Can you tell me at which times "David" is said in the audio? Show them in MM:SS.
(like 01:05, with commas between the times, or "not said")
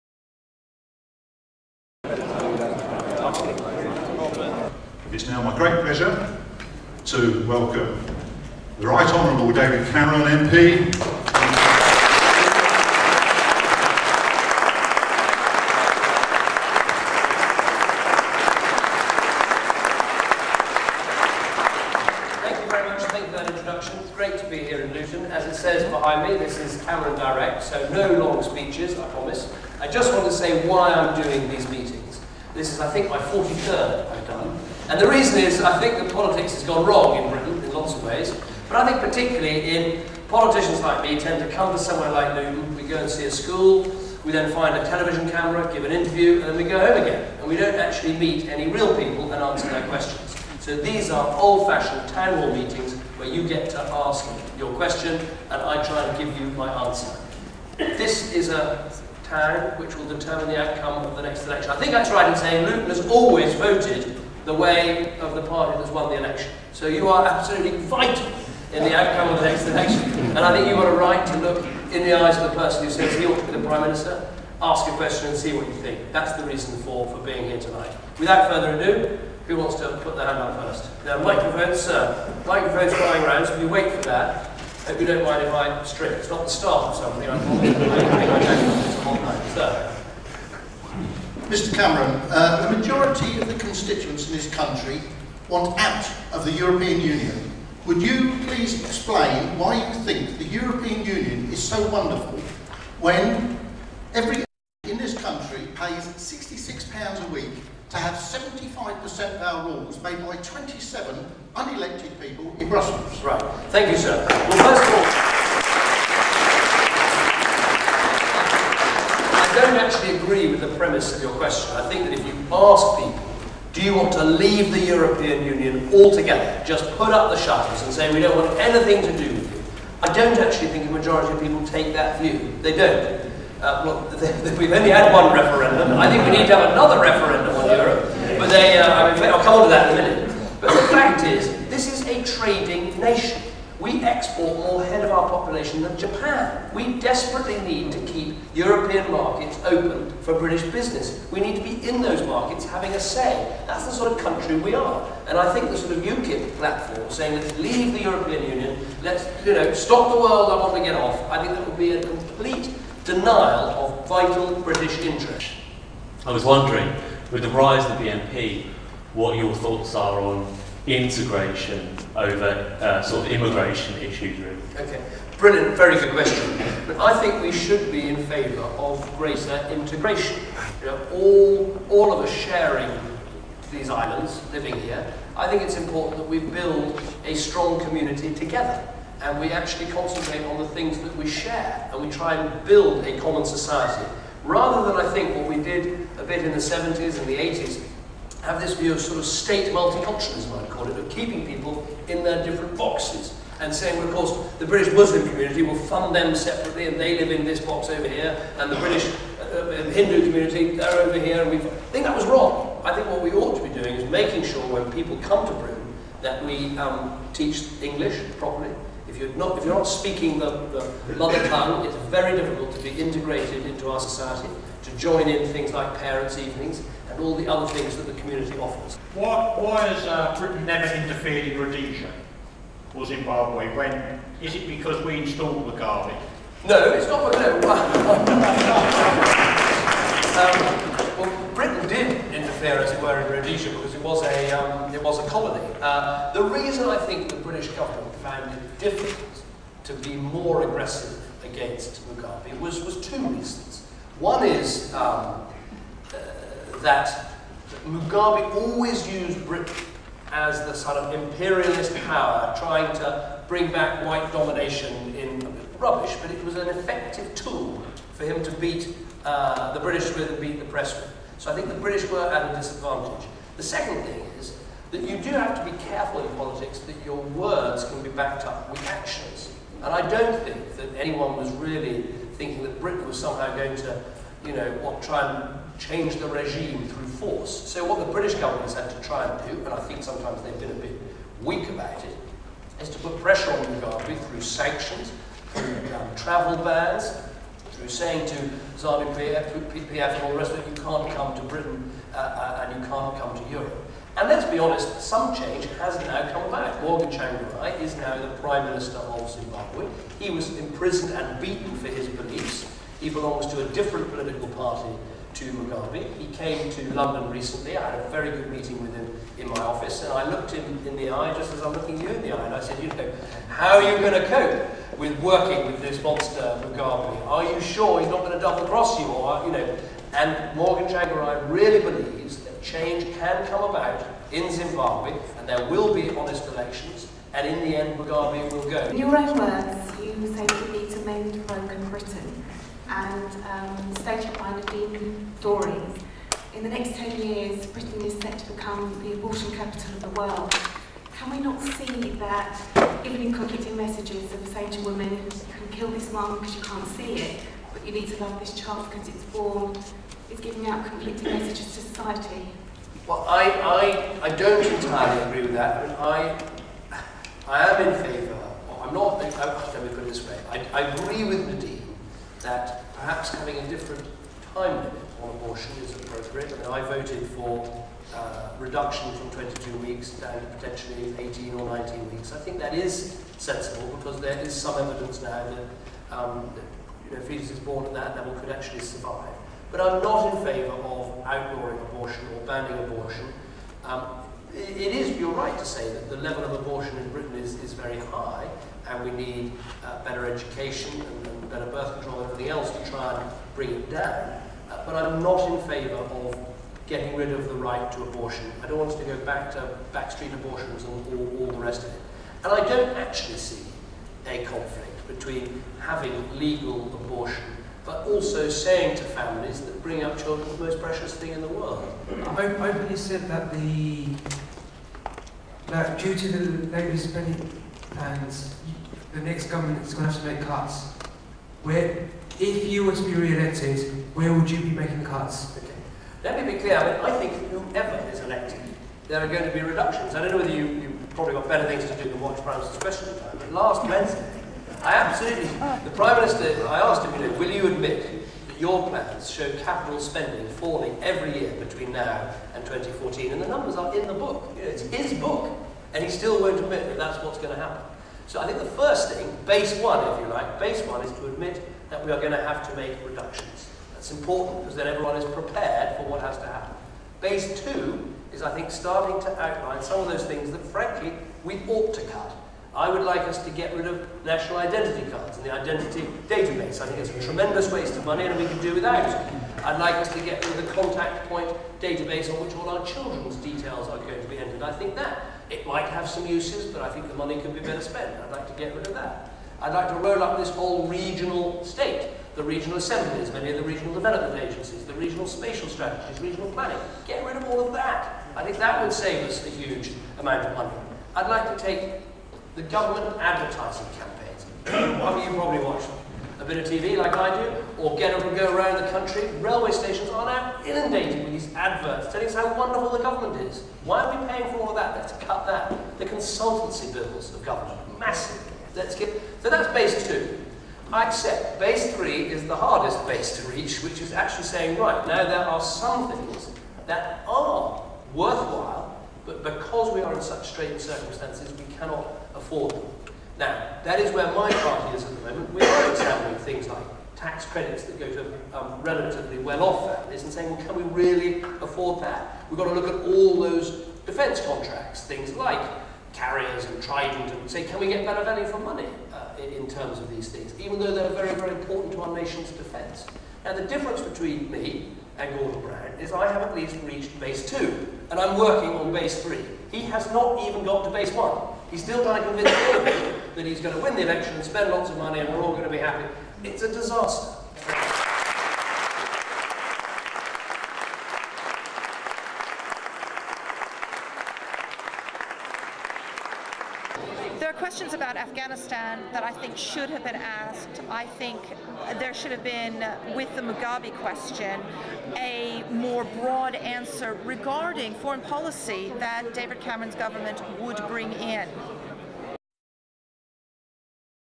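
00:09, 09:22, 09:49.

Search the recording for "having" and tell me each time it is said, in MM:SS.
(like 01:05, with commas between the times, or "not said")
02:32, 06:13, 06:55.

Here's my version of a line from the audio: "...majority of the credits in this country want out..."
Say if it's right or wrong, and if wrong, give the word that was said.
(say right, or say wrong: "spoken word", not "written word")
wrong: "constituents", not "credits".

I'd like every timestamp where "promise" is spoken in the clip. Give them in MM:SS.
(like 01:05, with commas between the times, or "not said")
00:29.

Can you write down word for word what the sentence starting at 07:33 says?
And the numbers are in the book.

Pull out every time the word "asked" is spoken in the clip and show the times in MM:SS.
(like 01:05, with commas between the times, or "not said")
07:26, 09:40.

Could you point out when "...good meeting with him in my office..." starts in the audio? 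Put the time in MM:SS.
05:18.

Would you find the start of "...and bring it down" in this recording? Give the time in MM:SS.
06:43.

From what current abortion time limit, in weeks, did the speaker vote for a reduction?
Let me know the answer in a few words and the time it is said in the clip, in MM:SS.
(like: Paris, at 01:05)
22 weeks, at 06:19.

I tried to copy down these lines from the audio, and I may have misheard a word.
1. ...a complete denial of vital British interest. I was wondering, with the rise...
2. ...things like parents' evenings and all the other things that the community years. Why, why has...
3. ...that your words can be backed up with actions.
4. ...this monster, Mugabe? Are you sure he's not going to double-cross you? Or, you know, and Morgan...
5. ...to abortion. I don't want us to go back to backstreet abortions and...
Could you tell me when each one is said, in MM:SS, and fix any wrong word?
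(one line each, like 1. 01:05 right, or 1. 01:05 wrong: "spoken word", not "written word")
1. 02:41 right
2. 03:45 wrong: "offers", not "years"
3. 04:36 right
4. 05:25 right
5. 06:47 right.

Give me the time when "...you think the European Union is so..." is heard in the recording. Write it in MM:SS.
01:39.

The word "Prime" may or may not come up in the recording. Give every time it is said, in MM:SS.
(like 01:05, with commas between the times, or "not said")
01:13, 05:08, 07:25.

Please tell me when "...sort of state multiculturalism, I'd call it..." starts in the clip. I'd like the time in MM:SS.
03:18.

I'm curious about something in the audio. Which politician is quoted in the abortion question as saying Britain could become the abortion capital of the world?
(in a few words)
Nadine Dorries.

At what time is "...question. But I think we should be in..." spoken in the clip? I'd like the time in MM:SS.
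02:56.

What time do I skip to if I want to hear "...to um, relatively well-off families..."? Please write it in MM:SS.
08:58.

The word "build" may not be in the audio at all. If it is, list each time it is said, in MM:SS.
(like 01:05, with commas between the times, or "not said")
03:06, 03:12.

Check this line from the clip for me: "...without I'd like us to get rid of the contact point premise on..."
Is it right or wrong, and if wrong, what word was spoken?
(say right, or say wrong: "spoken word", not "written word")
wrong: "database", not "premise".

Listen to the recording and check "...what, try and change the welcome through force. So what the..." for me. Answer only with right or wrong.
wrong.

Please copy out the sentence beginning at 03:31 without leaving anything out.
And we think that was wrong.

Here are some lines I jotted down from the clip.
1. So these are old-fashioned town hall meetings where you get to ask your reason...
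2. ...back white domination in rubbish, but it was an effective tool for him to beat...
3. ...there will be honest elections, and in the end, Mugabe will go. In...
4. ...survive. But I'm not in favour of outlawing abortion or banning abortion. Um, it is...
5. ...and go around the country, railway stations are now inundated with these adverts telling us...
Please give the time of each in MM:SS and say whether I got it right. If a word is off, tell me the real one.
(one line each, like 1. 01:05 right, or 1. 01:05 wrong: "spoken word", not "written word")
1. 00:50 wrong: "question", not "reason"
2. 04:23 right
3. 05:35 right
4. 06:28 right
5. 08:28 right.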